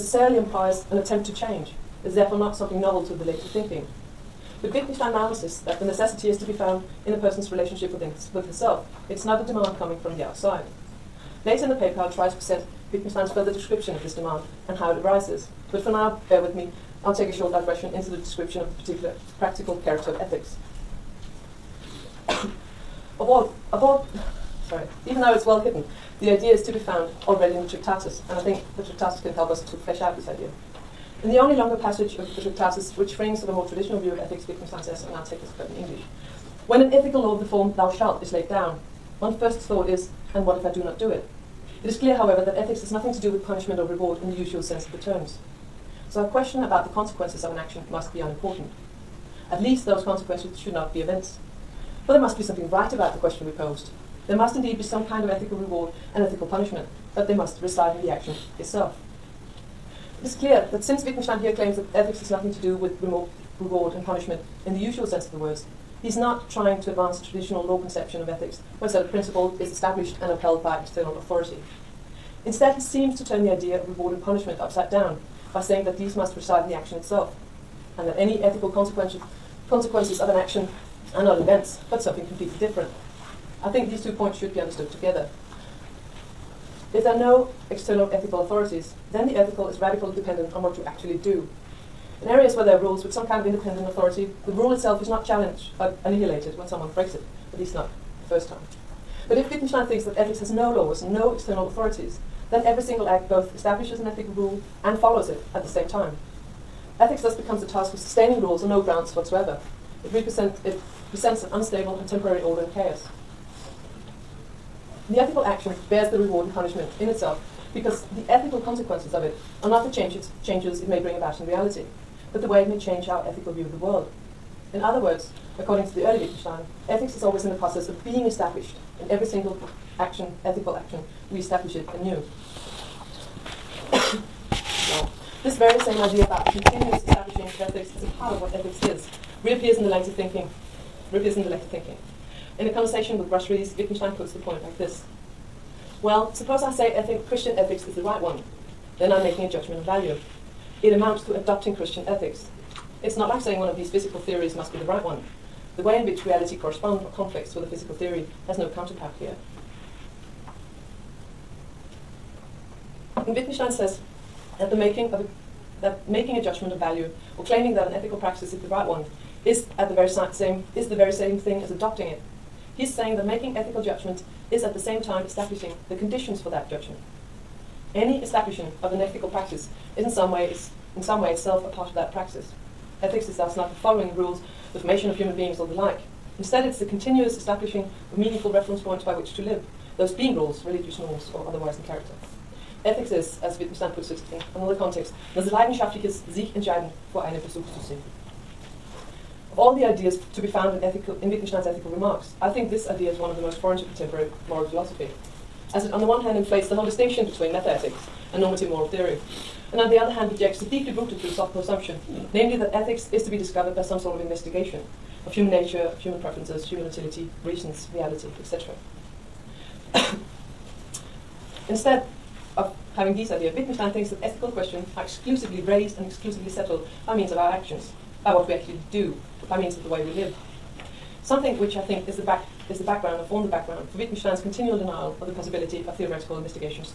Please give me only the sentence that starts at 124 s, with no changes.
In other words, according to the early Wittgenstein, ethics is always in the process of being established.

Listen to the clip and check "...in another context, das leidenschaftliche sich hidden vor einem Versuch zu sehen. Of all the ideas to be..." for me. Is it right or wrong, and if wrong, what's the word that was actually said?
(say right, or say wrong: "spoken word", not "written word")
wrong: "entscheiden", not "hidden".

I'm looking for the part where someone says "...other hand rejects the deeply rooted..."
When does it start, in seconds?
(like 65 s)
209 s.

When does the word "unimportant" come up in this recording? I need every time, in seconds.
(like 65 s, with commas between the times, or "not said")
48 s.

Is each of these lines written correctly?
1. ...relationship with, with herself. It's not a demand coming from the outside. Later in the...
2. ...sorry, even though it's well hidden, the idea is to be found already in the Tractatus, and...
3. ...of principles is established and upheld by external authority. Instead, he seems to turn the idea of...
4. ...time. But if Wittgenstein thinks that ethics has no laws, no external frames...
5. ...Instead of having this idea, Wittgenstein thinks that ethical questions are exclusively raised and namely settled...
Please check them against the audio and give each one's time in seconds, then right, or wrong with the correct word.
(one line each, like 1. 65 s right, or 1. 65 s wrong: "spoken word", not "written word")
1. 7 s right
2. 24 s right
3. 69 s right
4. 98 s wrong: "authorities", not "frames"
5. 221 s wrong: "exclusively", not "namely".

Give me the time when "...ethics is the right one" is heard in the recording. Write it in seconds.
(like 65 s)
147 s.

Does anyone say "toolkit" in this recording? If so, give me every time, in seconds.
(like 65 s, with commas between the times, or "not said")
not said.